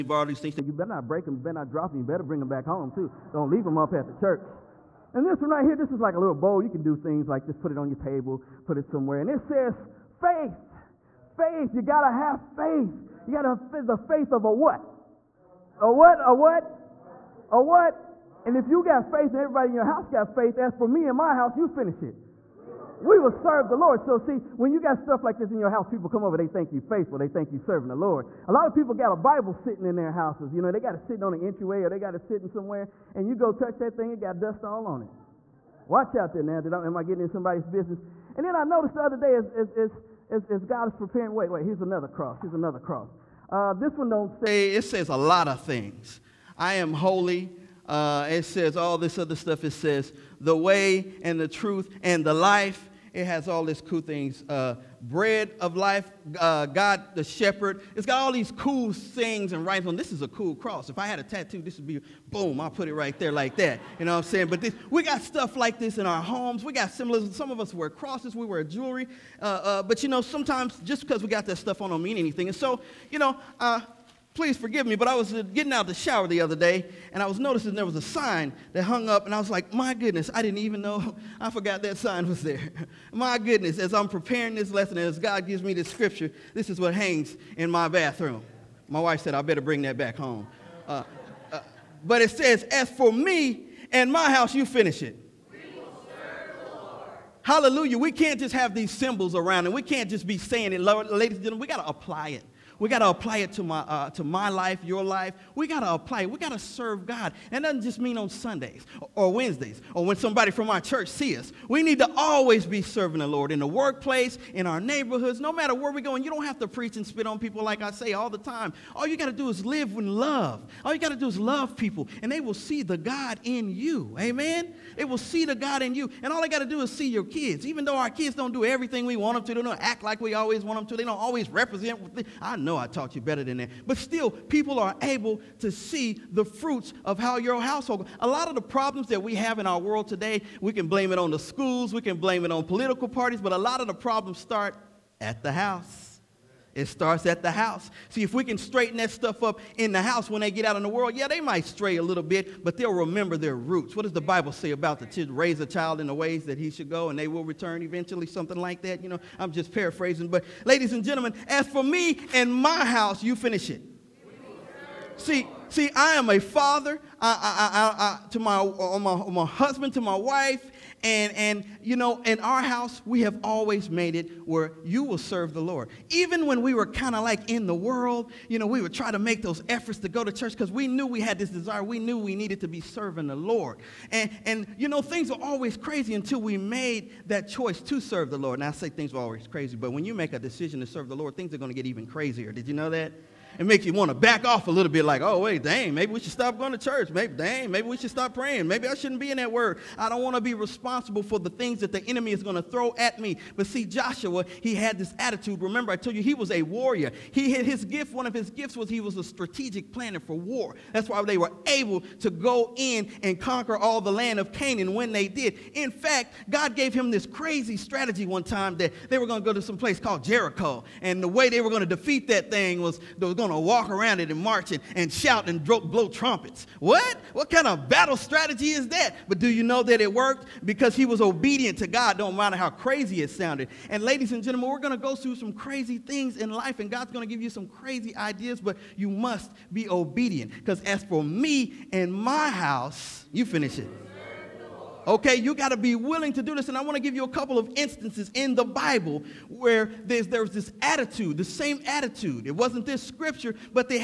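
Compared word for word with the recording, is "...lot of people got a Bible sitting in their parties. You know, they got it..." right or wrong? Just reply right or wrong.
wrong.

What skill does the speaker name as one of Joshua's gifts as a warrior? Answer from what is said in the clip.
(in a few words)
Strategic planner for war.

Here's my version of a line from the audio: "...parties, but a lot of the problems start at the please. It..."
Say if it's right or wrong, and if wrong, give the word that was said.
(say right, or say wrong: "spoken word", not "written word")
wrong: "house", not "please".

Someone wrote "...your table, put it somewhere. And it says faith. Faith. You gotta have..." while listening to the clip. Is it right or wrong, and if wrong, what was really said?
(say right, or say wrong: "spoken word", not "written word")
right.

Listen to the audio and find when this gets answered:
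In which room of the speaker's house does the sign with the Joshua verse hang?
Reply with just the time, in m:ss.
1:26.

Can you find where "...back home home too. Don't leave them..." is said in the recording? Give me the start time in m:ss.
0:02.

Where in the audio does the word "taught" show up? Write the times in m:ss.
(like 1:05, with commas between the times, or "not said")
2:12.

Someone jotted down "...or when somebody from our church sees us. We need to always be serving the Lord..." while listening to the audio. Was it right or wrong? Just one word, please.
right.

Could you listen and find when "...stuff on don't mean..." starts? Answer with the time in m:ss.
1:11.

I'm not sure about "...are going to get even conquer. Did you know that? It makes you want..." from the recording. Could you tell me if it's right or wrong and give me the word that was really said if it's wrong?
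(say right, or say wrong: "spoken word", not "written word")
wrong: "crazier", not "conquer".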